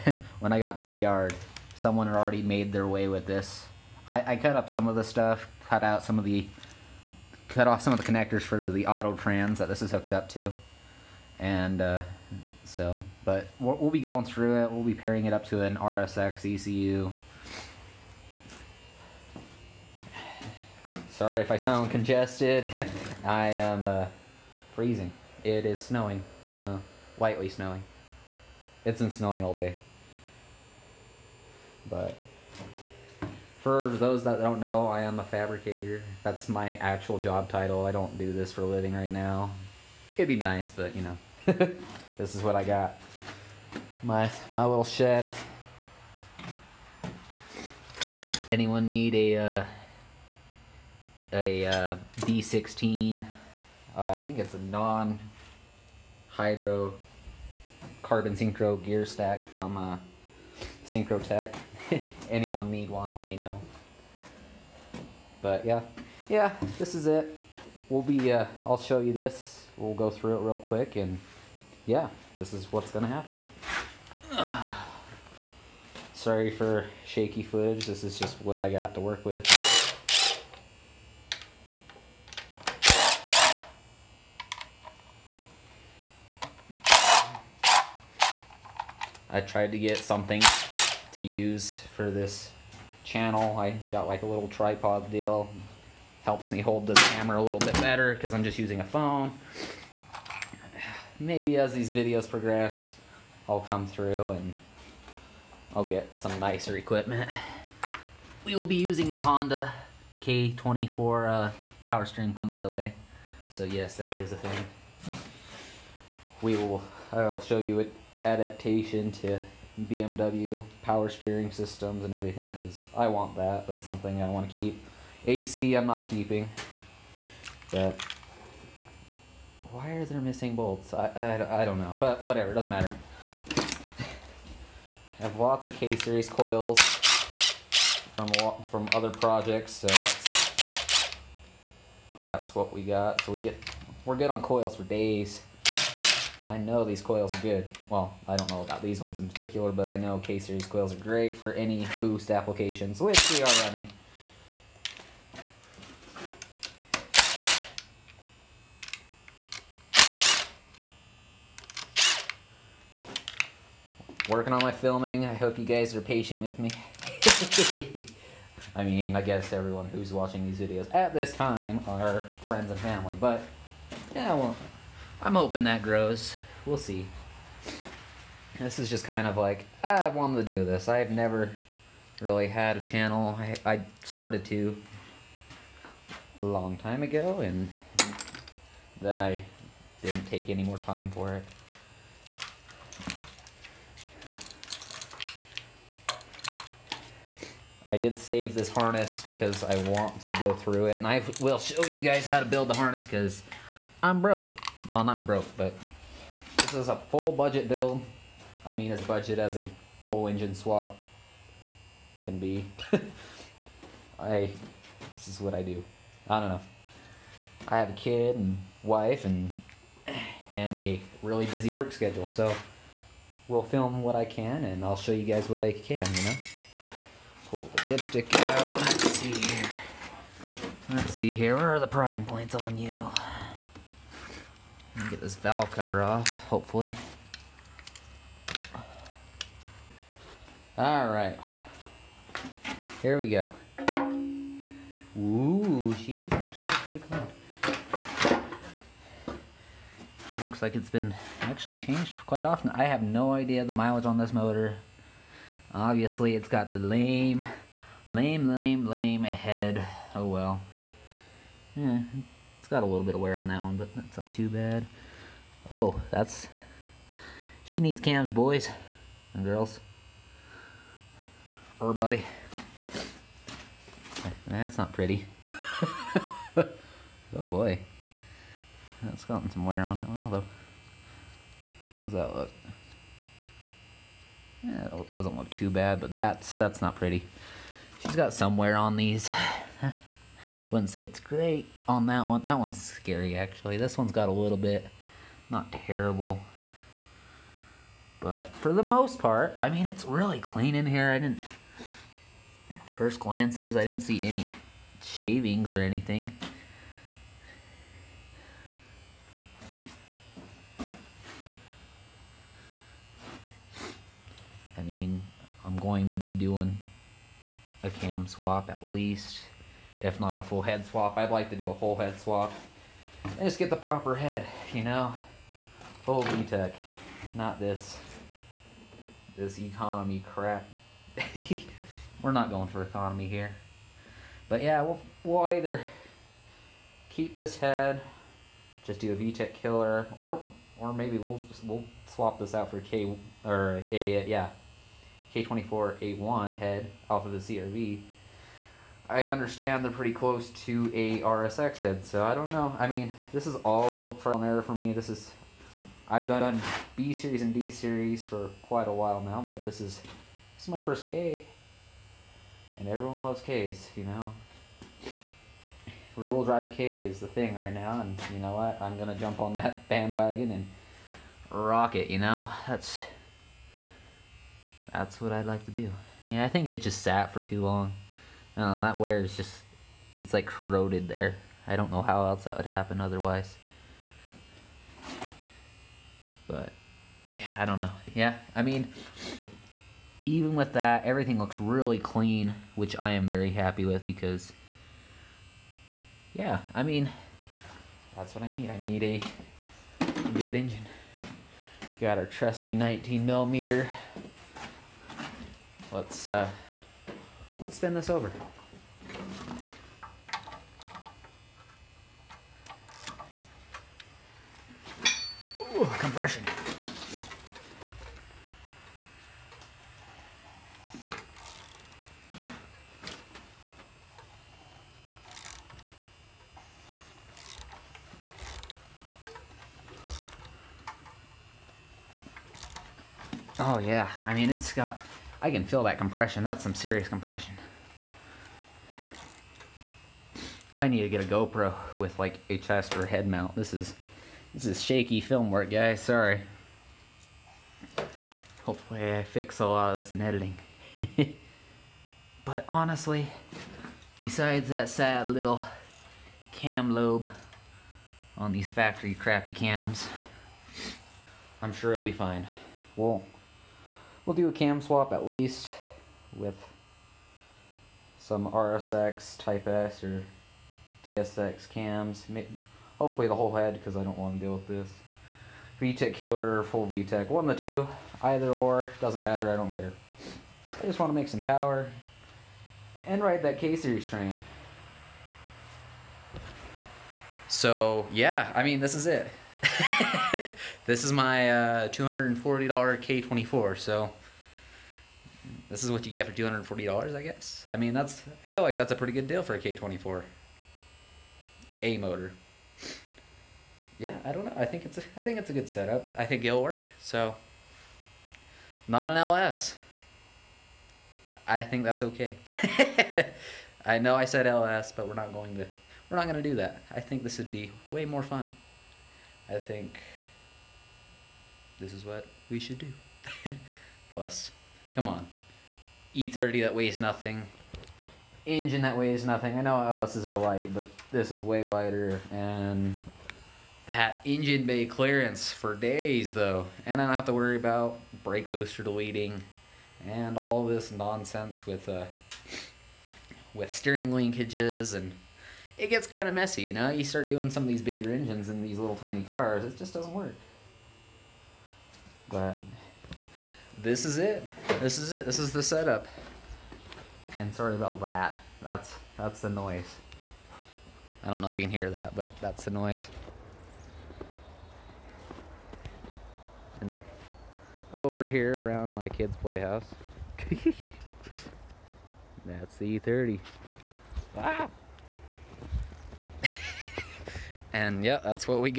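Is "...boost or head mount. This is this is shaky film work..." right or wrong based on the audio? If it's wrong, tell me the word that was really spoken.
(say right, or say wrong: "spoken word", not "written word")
wrong: "chest", not "boost".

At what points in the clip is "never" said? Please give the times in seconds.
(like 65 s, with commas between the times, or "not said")
181 s.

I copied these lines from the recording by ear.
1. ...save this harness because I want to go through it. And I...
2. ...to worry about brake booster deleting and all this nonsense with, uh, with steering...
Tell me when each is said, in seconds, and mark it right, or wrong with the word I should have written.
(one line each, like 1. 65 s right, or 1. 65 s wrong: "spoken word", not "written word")
1. 198 s right
2. 537 s right.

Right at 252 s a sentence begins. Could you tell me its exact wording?
I have no idea the mileage on this motor.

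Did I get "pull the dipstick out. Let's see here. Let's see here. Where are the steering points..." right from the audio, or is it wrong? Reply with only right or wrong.
wrong.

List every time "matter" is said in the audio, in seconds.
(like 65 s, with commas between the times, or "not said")
132 s, 479 s.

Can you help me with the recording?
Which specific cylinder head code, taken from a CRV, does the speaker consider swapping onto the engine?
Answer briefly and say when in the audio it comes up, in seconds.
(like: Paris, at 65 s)
K24A1, at 345 s.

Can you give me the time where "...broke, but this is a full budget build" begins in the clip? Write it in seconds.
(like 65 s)
205 s.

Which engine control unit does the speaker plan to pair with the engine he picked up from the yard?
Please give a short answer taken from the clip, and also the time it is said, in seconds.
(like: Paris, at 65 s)
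RSX ECU, at 15 s.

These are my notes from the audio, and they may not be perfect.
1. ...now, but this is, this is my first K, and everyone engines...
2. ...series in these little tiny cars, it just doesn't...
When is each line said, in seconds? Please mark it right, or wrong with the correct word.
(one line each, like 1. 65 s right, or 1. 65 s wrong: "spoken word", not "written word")
1. 359 s wrong: "loves", not "engines"
2. 548 s wrong: "engines", not "series".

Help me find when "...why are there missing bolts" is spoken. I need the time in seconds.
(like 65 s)
129 s.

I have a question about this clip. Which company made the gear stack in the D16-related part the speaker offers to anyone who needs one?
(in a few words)
Synchrotech.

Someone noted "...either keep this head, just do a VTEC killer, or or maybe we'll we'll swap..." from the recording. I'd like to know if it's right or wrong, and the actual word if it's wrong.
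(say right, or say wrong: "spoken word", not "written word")
right.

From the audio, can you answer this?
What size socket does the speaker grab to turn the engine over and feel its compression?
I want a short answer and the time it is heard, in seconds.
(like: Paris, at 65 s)
19 millimeter, at 402 s.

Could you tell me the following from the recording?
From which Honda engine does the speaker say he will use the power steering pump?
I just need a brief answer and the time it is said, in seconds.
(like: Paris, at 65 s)
K24, at 109 s.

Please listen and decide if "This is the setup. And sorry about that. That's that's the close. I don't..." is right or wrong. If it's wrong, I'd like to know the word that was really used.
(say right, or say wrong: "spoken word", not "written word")
wrong: "noise", not "close".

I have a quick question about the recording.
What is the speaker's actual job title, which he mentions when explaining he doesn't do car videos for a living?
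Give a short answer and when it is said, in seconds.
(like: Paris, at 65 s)
Fabricator, at 35 s.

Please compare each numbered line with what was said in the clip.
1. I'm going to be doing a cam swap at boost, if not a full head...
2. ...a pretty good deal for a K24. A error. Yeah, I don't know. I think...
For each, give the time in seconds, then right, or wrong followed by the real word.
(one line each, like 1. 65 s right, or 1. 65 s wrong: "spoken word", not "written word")
1. 315 s wrong: "least", not "boost"
2. 498 s wrong: "motor", not "error".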